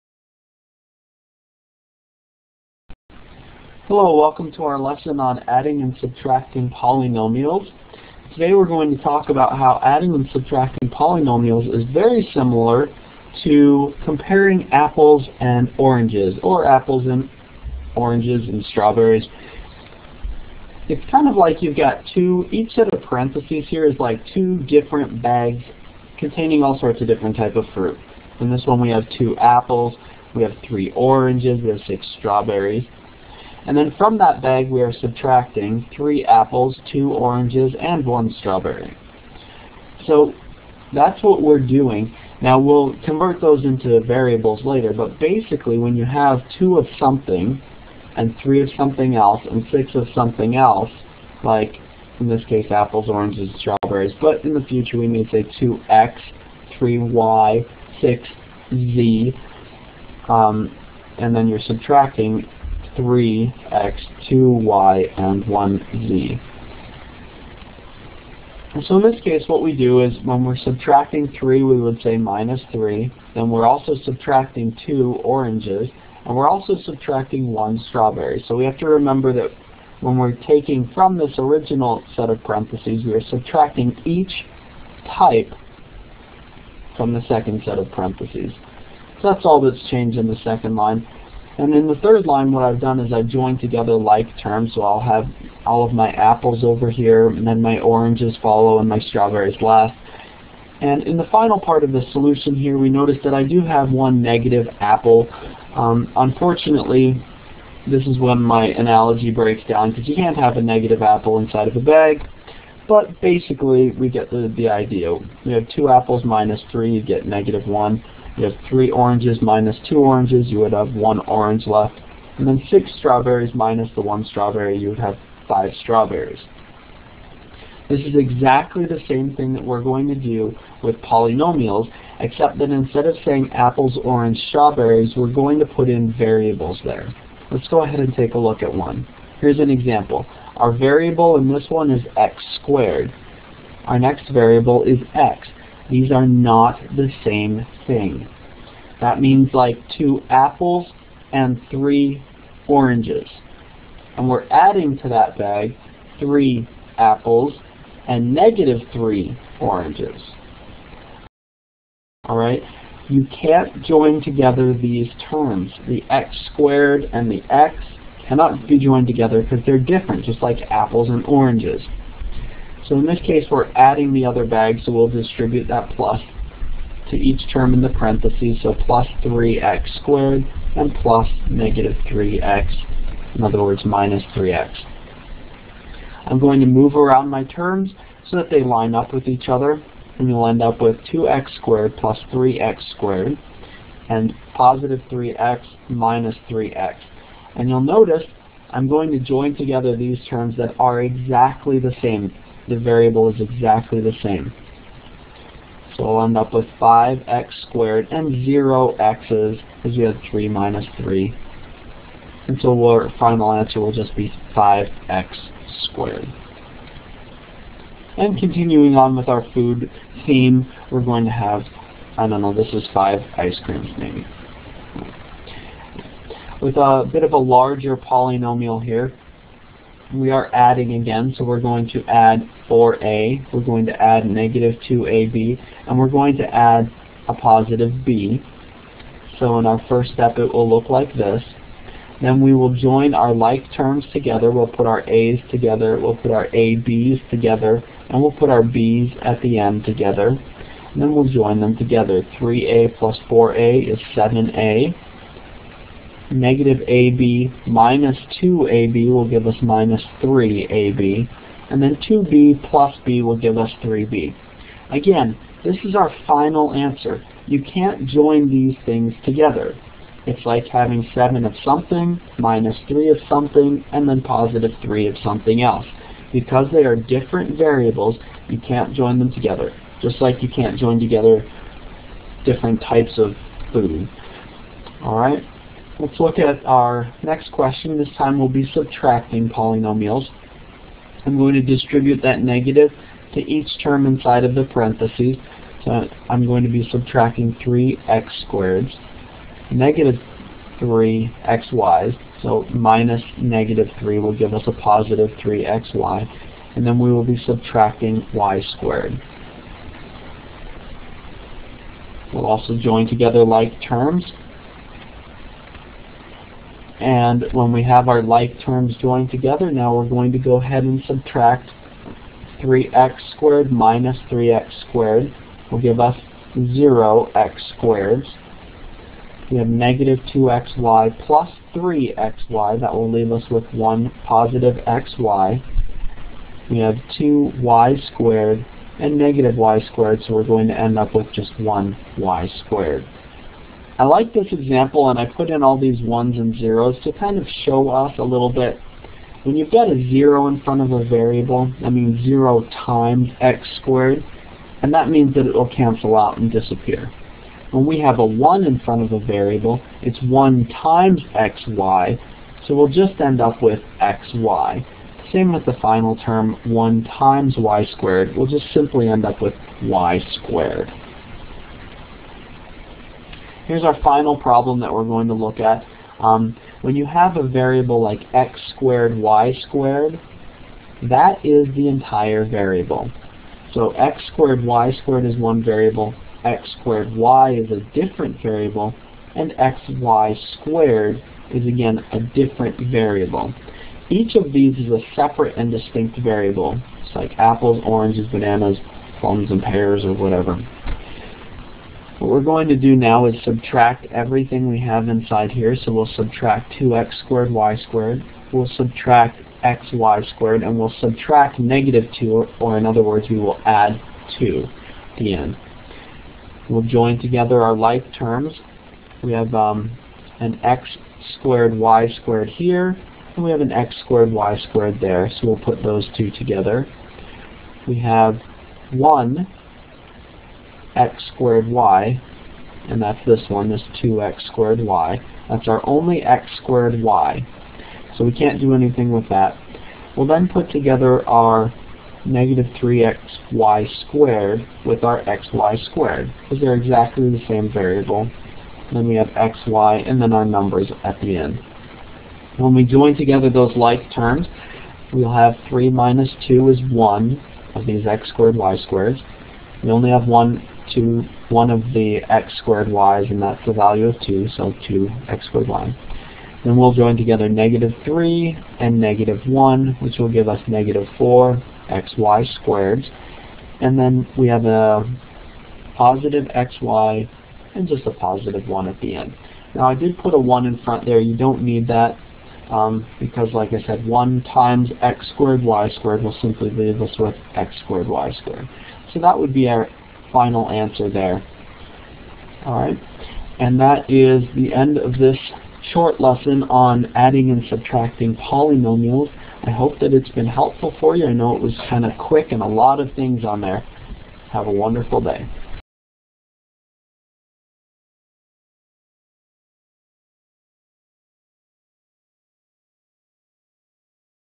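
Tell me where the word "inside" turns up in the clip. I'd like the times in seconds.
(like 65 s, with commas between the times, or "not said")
111 s, 294 s, 405 s.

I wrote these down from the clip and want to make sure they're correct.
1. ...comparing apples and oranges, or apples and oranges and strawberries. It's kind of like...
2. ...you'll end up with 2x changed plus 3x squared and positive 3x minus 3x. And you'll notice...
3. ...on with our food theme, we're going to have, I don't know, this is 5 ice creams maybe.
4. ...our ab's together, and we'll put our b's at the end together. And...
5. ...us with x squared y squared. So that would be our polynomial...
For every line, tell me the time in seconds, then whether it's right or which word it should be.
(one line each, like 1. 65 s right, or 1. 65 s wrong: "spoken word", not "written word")
1. 14 s right
2. 190 s wrong: "squared", not "changed"
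3. 218 s right
4. 246 s right
5. 487 s wrong: "final", not "polynomial".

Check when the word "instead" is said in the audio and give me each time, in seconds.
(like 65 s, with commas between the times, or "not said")
132 s.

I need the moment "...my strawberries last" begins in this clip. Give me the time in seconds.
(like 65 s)
98 s.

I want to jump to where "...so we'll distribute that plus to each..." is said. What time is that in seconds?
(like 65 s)
174 s.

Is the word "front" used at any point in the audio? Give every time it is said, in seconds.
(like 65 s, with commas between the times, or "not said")
350 s, 358 s, 480 s.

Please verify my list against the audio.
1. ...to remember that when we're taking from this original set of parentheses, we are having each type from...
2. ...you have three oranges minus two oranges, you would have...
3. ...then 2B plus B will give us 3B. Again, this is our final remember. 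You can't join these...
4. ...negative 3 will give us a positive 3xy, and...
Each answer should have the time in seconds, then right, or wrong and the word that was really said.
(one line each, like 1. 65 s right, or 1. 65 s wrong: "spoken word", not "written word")
1. 78 s wrong: "subtracting", not "having"
2. 118 s right
3. 261 s wrong: "answer", not "remember"
4. 303 s right.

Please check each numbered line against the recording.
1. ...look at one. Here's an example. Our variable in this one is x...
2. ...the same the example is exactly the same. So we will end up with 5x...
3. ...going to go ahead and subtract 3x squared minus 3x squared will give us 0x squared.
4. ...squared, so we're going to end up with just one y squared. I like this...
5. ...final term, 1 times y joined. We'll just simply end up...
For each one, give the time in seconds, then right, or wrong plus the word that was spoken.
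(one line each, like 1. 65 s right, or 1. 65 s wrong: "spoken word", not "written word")
1. 138 s right
2. 201 s wrong: "variable", not "example"
3. 320 s right
4. 339 s right
5. 365 s wrong: "squared", not "joined".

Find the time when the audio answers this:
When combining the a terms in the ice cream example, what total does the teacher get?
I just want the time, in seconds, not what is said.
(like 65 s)
254 s.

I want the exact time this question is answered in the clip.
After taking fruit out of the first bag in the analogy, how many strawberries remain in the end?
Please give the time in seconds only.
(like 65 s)
125 s.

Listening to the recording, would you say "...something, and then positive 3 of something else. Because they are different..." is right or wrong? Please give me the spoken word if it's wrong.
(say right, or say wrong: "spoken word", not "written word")
right.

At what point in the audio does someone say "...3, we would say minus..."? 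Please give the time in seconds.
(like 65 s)
71 s.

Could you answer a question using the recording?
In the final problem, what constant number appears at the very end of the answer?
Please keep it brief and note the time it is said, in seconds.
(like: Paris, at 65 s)
1, at 478 s.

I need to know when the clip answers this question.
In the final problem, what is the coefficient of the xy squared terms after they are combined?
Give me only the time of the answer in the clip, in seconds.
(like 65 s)
470 s.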